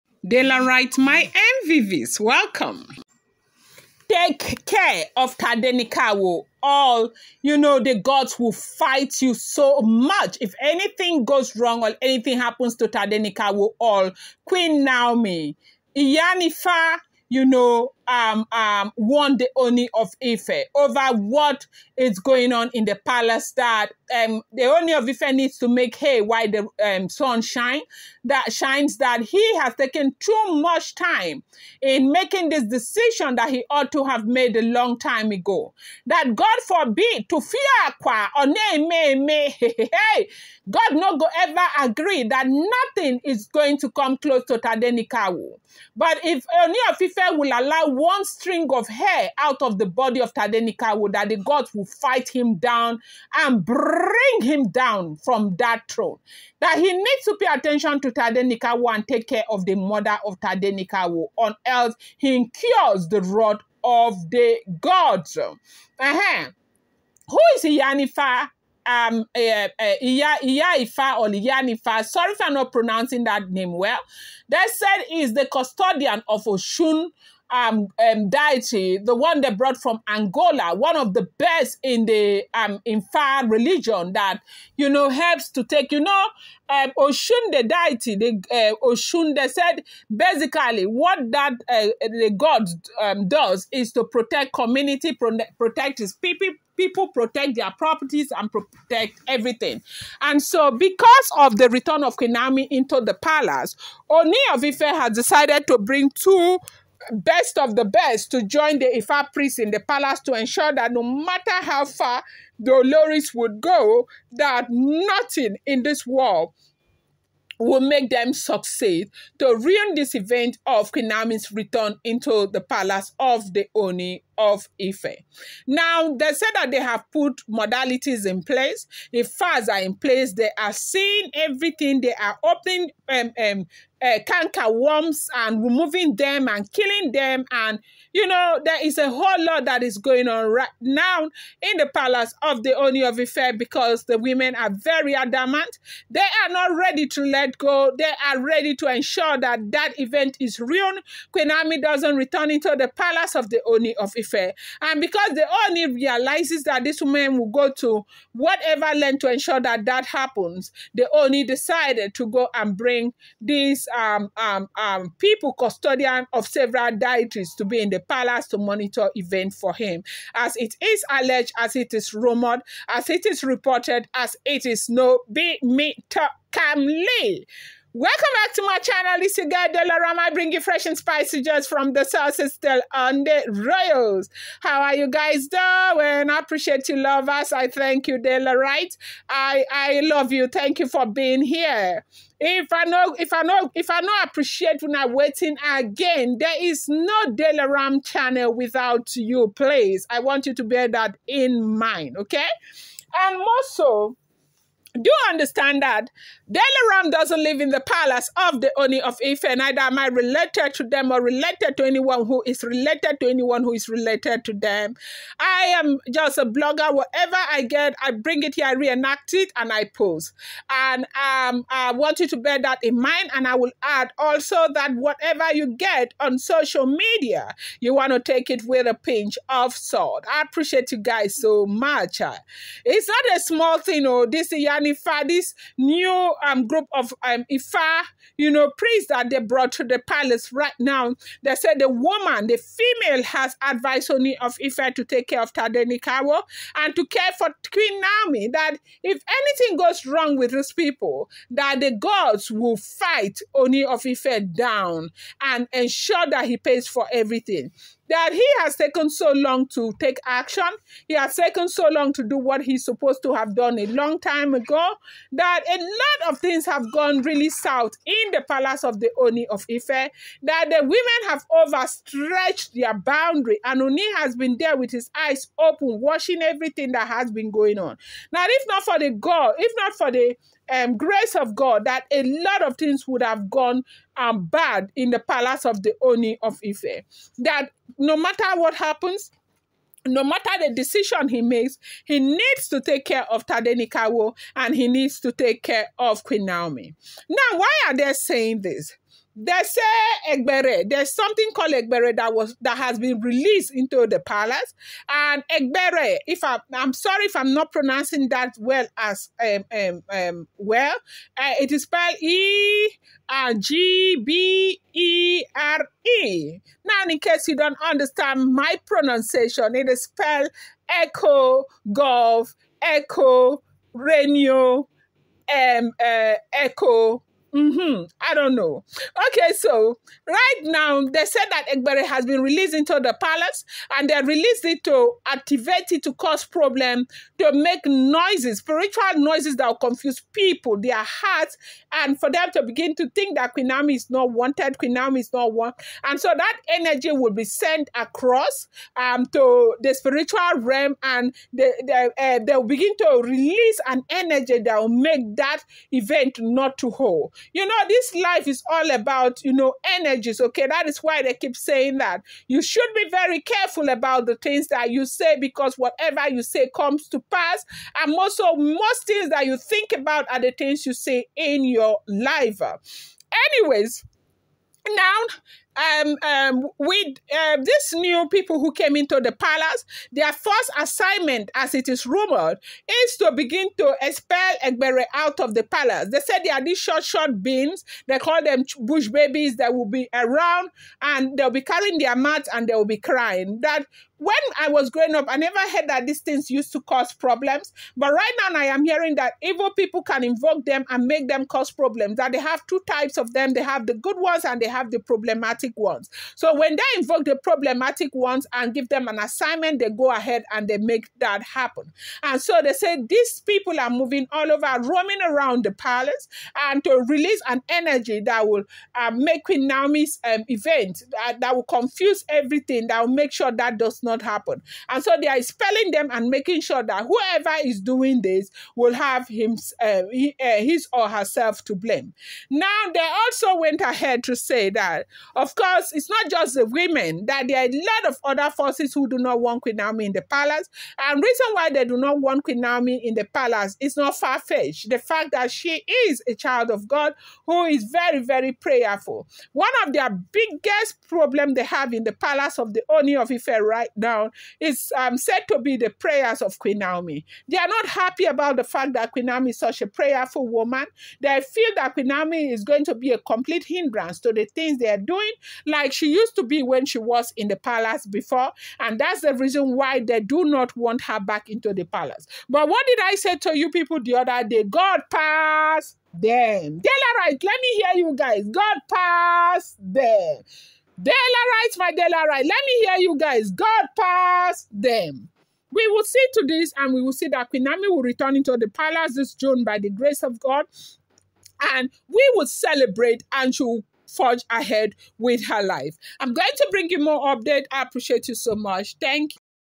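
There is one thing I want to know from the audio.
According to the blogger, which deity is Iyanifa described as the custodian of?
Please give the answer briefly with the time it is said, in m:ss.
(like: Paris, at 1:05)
Oshun, at 1:16.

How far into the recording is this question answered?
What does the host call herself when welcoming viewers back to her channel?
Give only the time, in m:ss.
2:59.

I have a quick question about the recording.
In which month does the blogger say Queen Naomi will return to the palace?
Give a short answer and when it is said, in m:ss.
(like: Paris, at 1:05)
June, at 8:09.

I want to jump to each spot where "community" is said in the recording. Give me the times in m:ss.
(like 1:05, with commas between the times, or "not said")
1:34.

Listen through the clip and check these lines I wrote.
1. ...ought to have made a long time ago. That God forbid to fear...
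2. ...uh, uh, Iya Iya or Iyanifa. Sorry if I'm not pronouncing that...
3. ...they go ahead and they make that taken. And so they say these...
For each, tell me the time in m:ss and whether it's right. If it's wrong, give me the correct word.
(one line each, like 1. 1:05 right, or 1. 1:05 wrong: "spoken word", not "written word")
1. 0:33 right
2. 1:09 right
3. 6:49 wrong: "happen", not "taken".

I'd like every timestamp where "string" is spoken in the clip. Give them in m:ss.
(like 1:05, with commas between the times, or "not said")
0:48.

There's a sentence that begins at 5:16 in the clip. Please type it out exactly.
Now, in case you don't understand my pronunciation, it is spelled Echo Golf Echo Radio um uh, Echo Mm-hmm.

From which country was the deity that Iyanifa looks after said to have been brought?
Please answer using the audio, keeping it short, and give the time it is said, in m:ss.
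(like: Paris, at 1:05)
Angola, at 1:20.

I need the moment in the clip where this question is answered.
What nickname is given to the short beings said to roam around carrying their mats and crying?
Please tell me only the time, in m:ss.
6:28.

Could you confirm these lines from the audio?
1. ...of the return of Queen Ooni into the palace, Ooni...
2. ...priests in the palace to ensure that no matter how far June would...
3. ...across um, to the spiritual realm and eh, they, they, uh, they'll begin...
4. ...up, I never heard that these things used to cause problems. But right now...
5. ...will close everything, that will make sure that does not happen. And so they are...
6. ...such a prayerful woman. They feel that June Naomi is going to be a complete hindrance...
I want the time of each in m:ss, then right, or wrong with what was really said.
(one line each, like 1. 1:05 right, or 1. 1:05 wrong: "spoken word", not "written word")
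1. 1:41 wrong: "Naomi", not "Ooni"
2. 1:49 wrong: "Dolores", not "June"
3. 5:47 right
4. 6:35 right
5. 7:01 wrong: "confuse", not "close"
6. 7:39 wrong: "Queen", not "June".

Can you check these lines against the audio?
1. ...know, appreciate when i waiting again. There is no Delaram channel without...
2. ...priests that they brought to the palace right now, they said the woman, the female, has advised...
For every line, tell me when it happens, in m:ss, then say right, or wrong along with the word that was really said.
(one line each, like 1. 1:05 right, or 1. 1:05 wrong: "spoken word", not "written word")
1. 3:13 right
2. 3:58 right.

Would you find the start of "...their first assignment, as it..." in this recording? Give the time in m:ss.
6:20.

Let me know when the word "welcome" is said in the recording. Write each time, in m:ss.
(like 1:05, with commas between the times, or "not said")
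0:02, 2:57.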